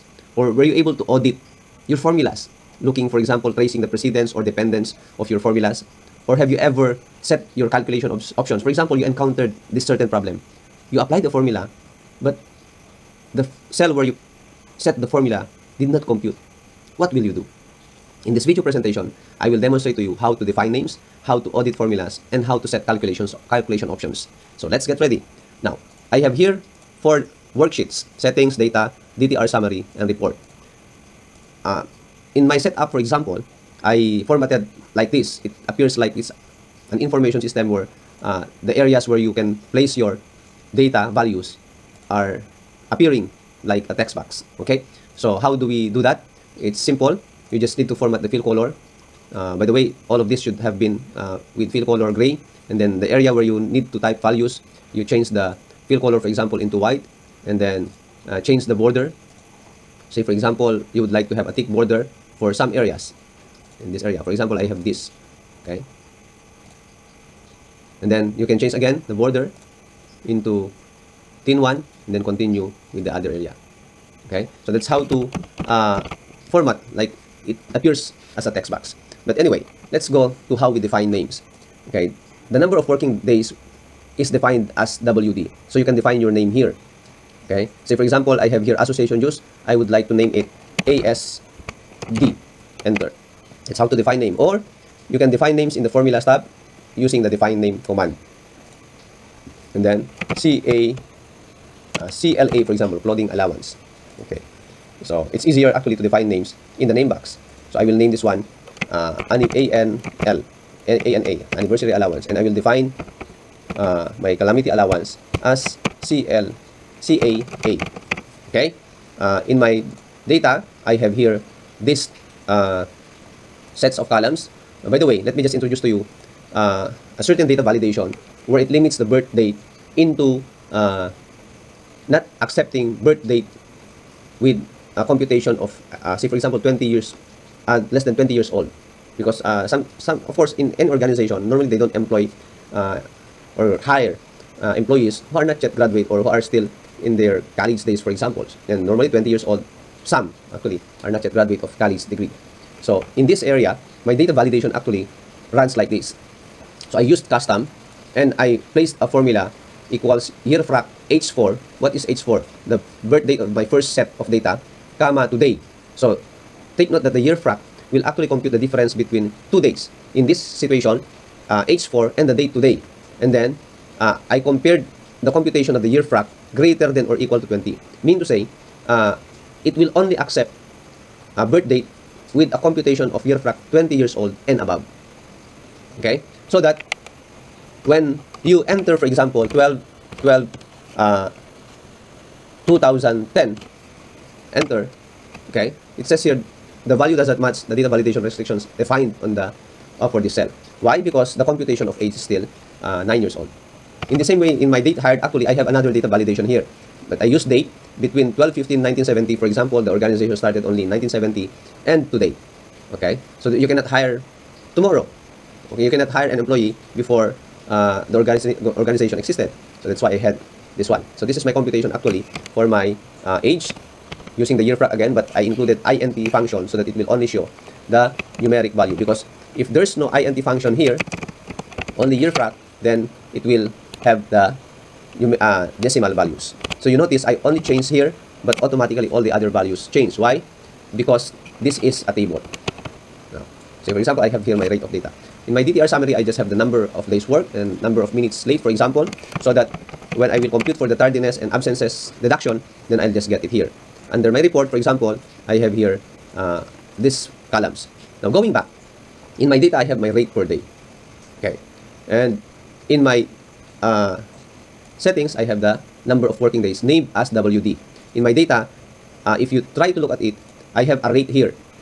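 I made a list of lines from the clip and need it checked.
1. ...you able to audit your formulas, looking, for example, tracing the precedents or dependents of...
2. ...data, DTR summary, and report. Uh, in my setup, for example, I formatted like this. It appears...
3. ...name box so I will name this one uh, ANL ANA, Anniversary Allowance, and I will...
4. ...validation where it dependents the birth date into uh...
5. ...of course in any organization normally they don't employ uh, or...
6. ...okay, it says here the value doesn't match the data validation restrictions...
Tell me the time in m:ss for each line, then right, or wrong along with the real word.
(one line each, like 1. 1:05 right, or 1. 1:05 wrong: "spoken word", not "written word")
1. 0:00 right
2. 0:28 right
3. 1:46 right
4. 2:07 wrong: "limits", not "dependents"
5. 2:20 right
6. 3:15 right.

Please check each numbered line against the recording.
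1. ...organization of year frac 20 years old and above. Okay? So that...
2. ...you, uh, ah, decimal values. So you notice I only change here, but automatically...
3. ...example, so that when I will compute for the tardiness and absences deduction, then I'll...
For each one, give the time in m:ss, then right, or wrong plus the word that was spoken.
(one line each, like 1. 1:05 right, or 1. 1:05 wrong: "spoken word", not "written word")
1. 3:02 wrong: "computation", not "organization"
2. 3:55 right
3. 4:08 right.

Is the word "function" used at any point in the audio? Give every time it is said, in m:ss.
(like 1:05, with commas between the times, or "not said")
3:46, 3:50.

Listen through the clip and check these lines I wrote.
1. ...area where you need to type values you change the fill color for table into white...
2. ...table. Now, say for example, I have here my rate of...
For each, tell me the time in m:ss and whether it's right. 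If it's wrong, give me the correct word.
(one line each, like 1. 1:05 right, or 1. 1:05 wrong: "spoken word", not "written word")
1. 0:53 wrong: "example", not "table"
2. 4:02 right.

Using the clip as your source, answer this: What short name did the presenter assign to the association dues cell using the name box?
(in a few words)
ASD.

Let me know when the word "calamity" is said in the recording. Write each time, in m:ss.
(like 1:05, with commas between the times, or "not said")
1:54.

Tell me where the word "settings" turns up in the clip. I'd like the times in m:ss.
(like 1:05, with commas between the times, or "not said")
0:28, 4:24.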